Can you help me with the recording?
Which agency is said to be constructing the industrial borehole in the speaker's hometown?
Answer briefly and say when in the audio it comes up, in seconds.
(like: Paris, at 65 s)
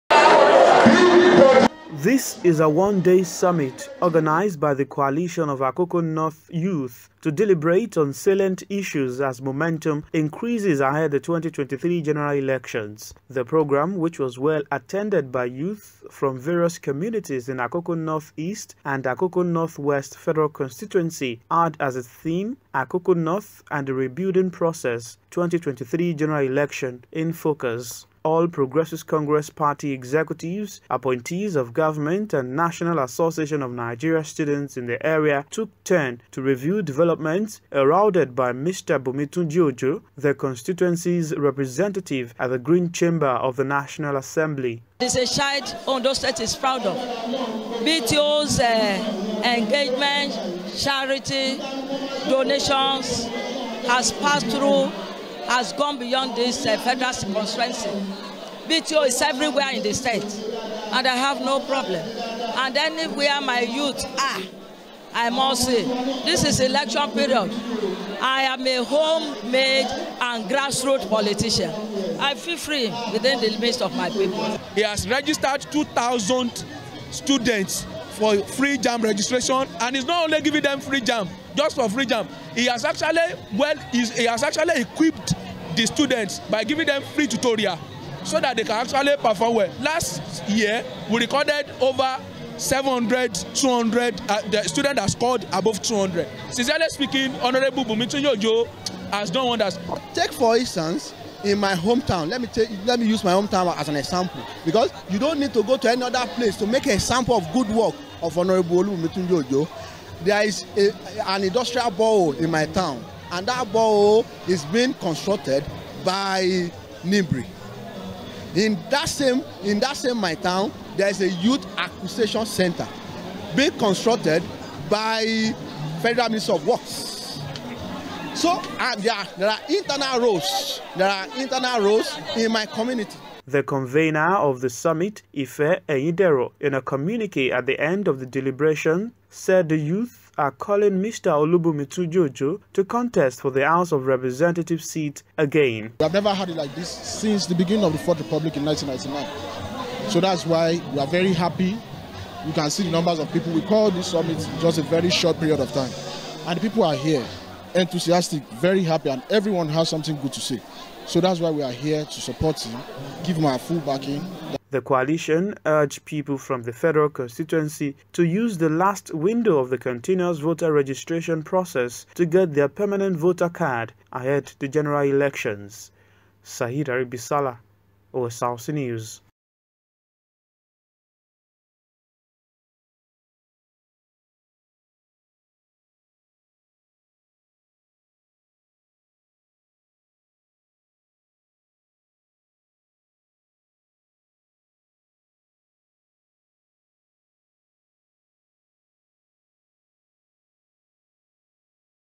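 Nibri, at 117 s.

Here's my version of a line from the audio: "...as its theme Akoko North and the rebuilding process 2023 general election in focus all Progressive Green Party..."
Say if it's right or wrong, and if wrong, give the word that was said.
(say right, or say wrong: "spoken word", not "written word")
wrong: "Congress", not "Green".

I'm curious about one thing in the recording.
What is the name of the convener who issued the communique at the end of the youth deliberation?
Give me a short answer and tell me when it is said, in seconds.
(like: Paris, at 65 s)
Ife Eidero, at 135 s.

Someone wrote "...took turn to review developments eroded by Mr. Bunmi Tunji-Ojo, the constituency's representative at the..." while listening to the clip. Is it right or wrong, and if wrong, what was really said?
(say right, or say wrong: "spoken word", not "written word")
right.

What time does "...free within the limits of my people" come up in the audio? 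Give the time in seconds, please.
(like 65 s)
72 s.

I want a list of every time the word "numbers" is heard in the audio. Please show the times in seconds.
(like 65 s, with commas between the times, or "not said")
152 s.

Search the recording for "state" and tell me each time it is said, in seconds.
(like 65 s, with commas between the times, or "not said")
46 s, 59 s.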